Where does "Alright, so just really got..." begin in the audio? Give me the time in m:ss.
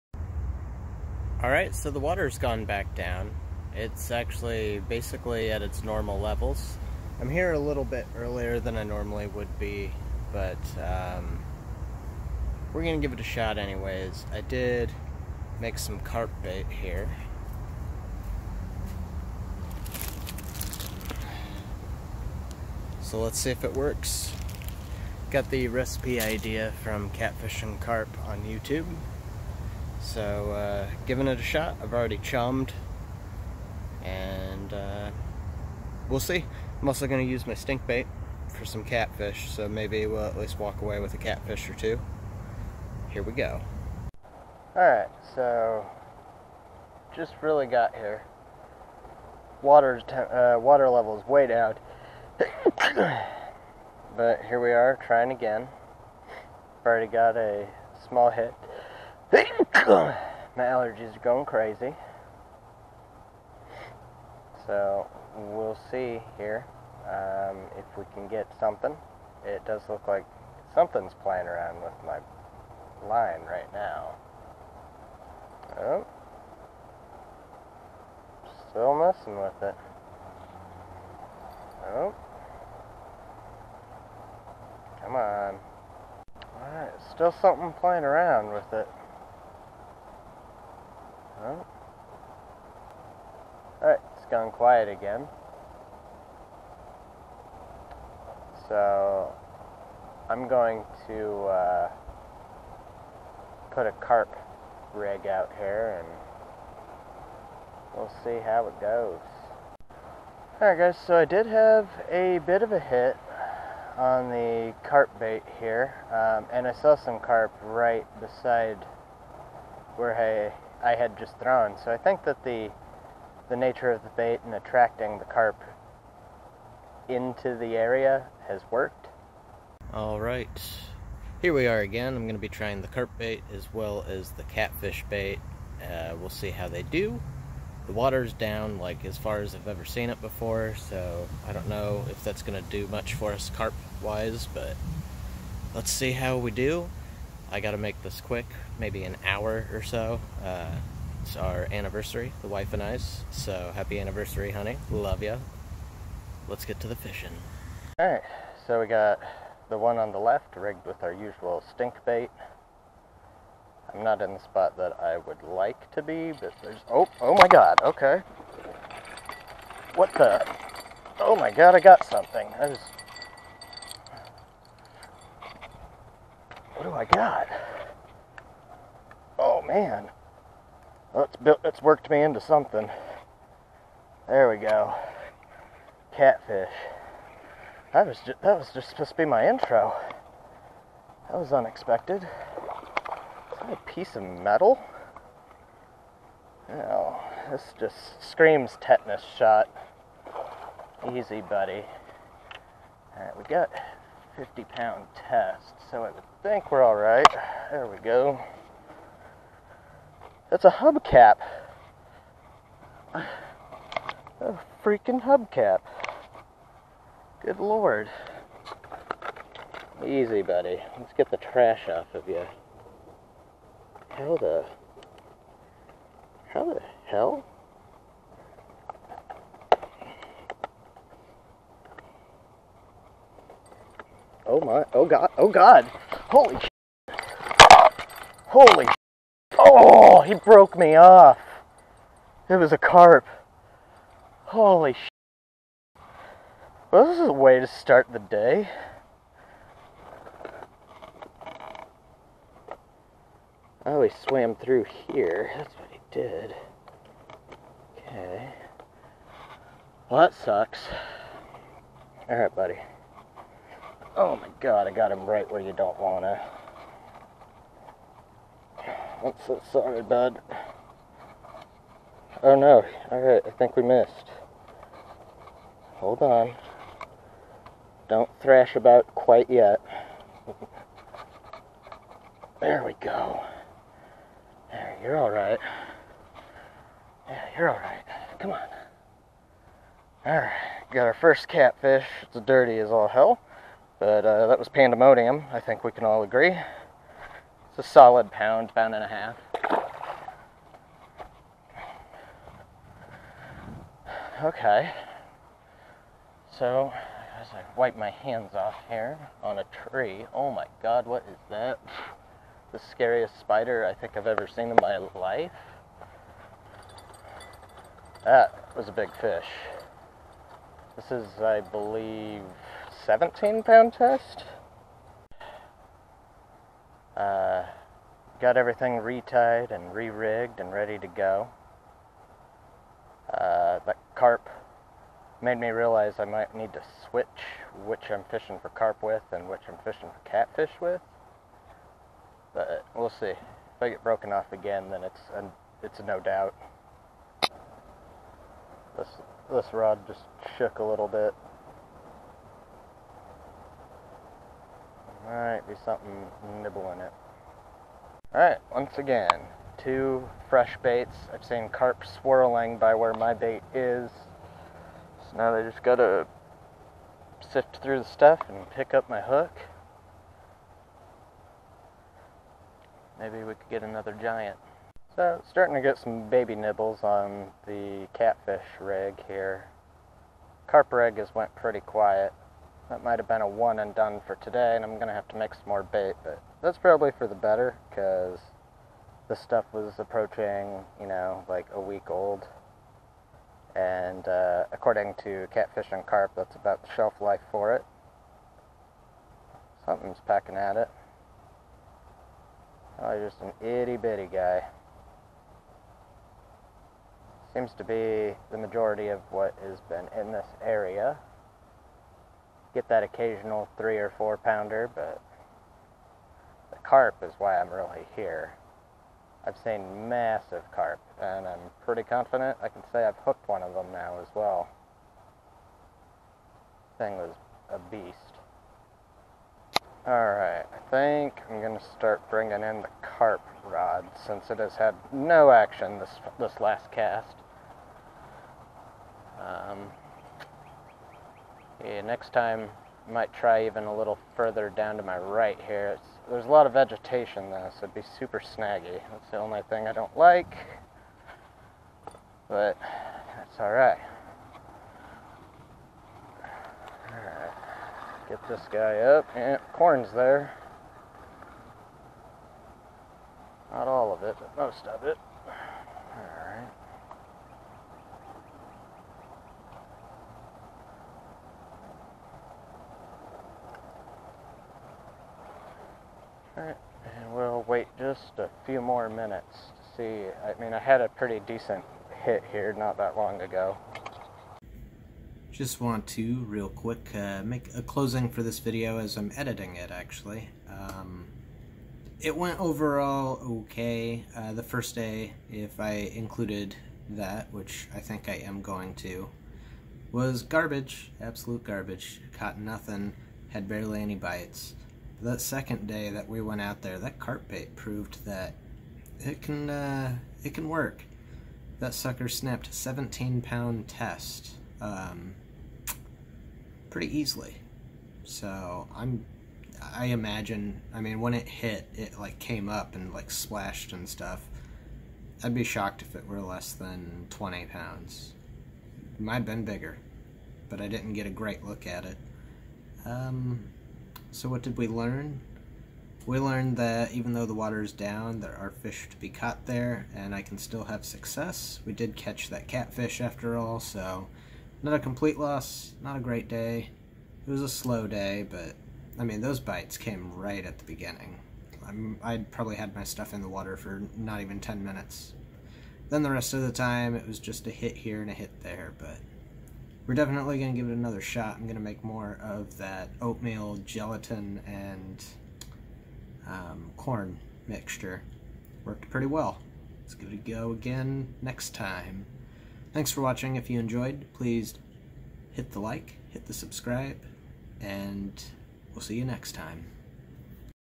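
0:44.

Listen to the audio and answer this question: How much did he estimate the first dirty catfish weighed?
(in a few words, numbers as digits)
1 to 1.5 pounds.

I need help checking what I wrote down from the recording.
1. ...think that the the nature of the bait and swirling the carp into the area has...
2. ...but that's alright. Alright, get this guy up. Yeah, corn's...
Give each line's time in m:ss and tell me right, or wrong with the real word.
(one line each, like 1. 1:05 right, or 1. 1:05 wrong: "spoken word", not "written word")
1. 2:01 wrong: "attracting", not "swirling"
2. 7:32 right.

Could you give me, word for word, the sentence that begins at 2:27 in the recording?
I got to make this quick, maybe an hour or so.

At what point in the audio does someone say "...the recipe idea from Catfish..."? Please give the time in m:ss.
0:25.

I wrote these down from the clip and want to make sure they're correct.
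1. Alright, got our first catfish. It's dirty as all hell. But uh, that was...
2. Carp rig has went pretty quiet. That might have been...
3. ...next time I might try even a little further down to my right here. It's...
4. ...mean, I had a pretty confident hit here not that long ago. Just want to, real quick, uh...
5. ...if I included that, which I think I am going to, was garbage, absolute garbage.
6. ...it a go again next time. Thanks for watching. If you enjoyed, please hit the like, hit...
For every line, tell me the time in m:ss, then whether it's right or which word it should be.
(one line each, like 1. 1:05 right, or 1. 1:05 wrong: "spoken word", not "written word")
1. 4:50 right
2. 6:20 right
3. 7:22 right
4. 8:00 wrong: "decent", not "confident"
5. 8:15 right
6. 9:30 right.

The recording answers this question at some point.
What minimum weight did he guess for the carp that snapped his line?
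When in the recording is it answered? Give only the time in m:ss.
8:47.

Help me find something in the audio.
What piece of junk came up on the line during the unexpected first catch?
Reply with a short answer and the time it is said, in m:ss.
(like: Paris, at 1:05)
A hubcap, at 3:33.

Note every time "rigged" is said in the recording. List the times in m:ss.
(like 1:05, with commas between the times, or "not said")
2:40, 5:29.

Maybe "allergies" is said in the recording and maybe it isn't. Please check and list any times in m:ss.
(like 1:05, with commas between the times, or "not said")
1:00.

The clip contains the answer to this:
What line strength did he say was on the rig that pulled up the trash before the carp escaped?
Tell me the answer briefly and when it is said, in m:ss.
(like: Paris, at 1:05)
50 pound test, at 3:24.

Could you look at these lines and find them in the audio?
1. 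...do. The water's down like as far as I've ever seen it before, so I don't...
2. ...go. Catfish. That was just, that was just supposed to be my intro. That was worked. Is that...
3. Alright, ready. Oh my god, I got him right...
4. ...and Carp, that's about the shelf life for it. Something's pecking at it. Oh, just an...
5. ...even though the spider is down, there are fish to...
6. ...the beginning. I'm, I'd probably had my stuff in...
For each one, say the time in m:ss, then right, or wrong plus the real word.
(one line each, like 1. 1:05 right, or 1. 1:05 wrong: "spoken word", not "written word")
1. 2:16 right
2. 3:04 wrong: "unexpected", not "worked"
3. 4:22 wrong: "buddy", not "ready"
4. 6:35 right
5. 8:57 wrong: "water", not "spider"
6. 9:10 right.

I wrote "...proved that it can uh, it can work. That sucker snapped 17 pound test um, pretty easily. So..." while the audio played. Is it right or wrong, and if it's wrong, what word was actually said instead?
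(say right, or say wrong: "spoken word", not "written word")
right.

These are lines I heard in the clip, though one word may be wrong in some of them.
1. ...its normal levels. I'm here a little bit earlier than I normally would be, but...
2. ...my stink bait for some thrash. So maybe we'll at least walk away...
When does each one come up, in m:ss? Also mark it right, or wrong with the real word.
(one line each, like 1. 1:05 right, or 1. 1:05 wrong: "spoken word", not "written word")
1. 0:05 right
2. 0:37 wrong: "catfish", not "thrash".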